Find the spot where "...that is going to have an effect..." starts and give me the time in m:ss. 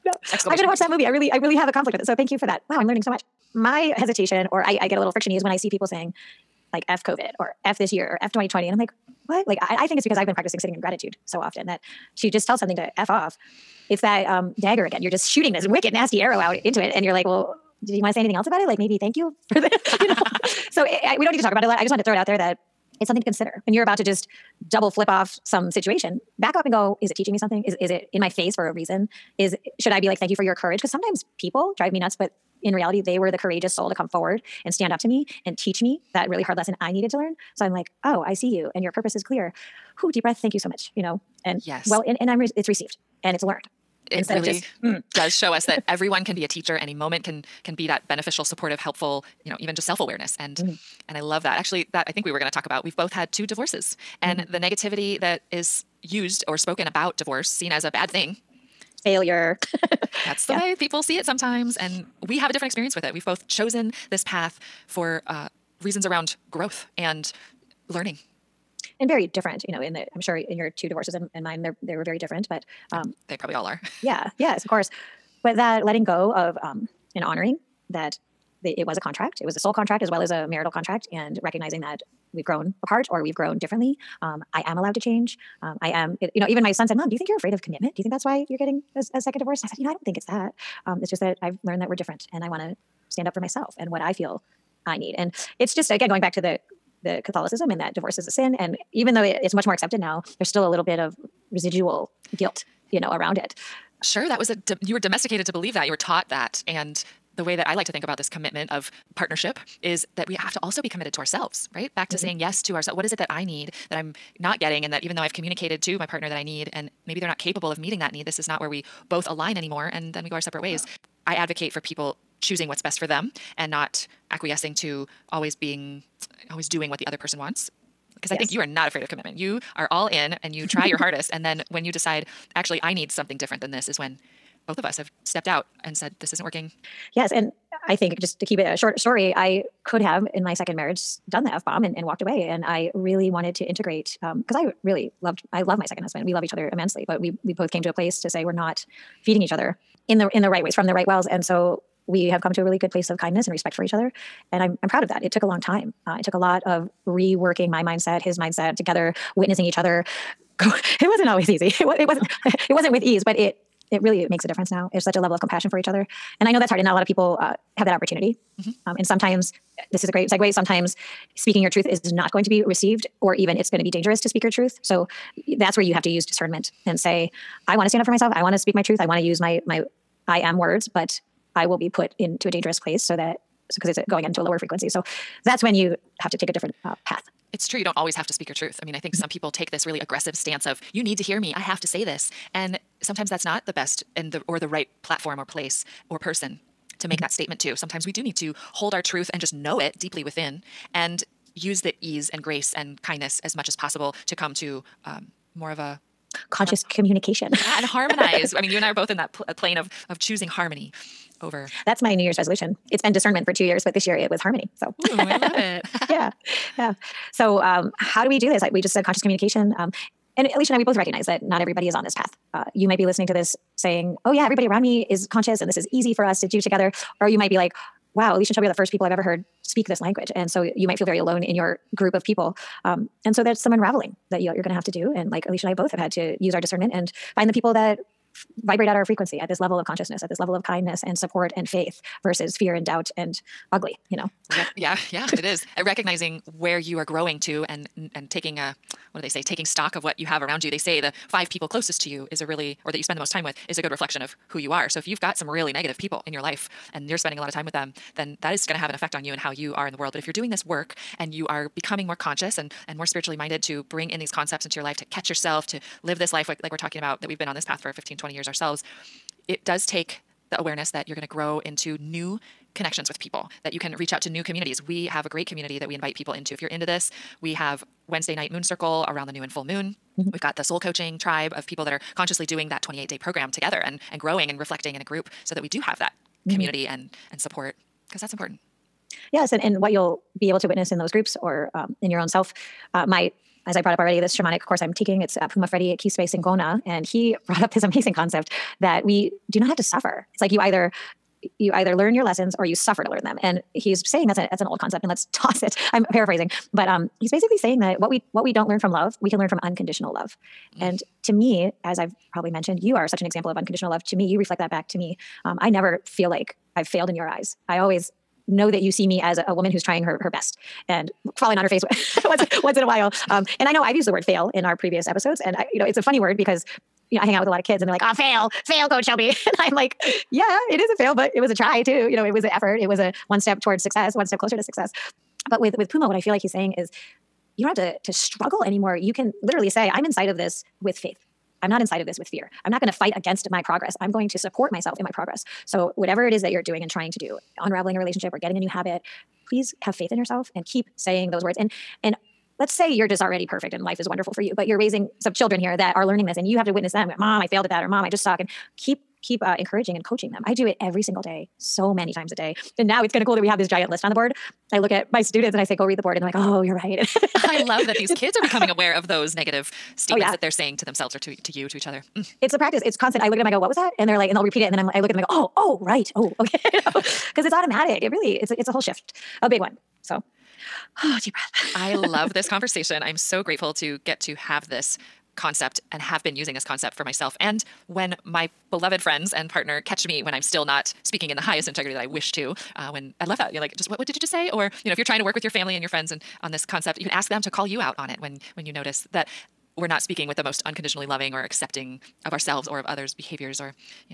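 4:18.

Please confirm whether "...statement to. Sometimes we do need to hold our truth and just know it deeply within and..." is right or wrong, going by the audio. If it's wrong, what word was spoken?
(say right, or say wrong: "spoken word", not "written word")
right.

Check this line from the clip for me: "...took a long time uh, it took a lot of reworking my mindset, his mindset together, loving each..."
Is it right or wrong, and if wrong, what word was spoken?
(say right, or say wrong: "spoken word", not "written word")
wrong: "witnessing", not "loving".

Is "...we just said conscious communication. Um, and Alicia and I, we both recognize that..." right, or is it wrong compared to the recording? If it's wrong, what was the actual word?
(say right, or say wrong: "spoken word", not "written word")
right.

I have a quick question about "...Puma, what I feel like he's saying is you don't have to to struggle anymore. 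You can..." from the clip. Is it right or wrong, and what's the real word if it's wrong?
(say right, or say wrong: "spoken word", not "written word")
right.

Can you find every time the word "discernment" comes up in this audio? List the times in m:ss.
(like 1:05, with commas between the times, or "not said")
2:56, 3:33, 3:56.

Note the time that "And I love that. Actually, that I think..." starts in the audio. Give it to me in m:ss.
0:51.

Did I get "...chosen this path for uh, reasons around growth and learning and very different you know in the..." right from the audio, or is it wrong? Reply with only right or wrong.
right.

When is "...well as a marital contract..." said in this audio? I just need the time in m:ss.
1:20.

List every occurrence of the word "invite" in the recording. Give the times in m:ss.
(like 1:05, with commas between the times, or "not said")
4:35.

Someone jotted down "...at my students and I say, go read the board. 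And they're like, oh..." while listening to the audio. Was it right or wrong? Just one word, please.
right.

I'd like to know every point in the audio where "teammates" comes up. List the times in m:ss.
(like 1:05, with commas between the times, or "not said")
not said.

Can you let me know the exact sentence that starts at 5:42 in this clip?
I'm not going to fight against my progress.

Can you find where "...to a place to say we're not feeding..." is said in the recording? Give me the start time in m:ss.
2:27.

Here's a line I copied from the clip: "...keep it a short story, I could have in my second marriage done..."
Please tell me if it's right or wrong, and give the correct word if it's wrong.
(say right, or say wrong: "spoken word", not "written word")
right.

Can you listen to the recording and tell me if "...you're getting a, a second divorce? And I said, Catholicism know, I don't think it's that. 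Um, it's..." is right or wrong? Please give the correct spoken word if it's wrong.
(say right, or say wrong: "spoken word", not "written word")
wrong: "You", not "Catholicism".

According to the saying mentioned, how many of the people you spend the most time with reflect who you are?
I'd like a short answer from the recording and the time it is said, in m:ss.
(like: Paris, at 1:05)
5, at 4:11.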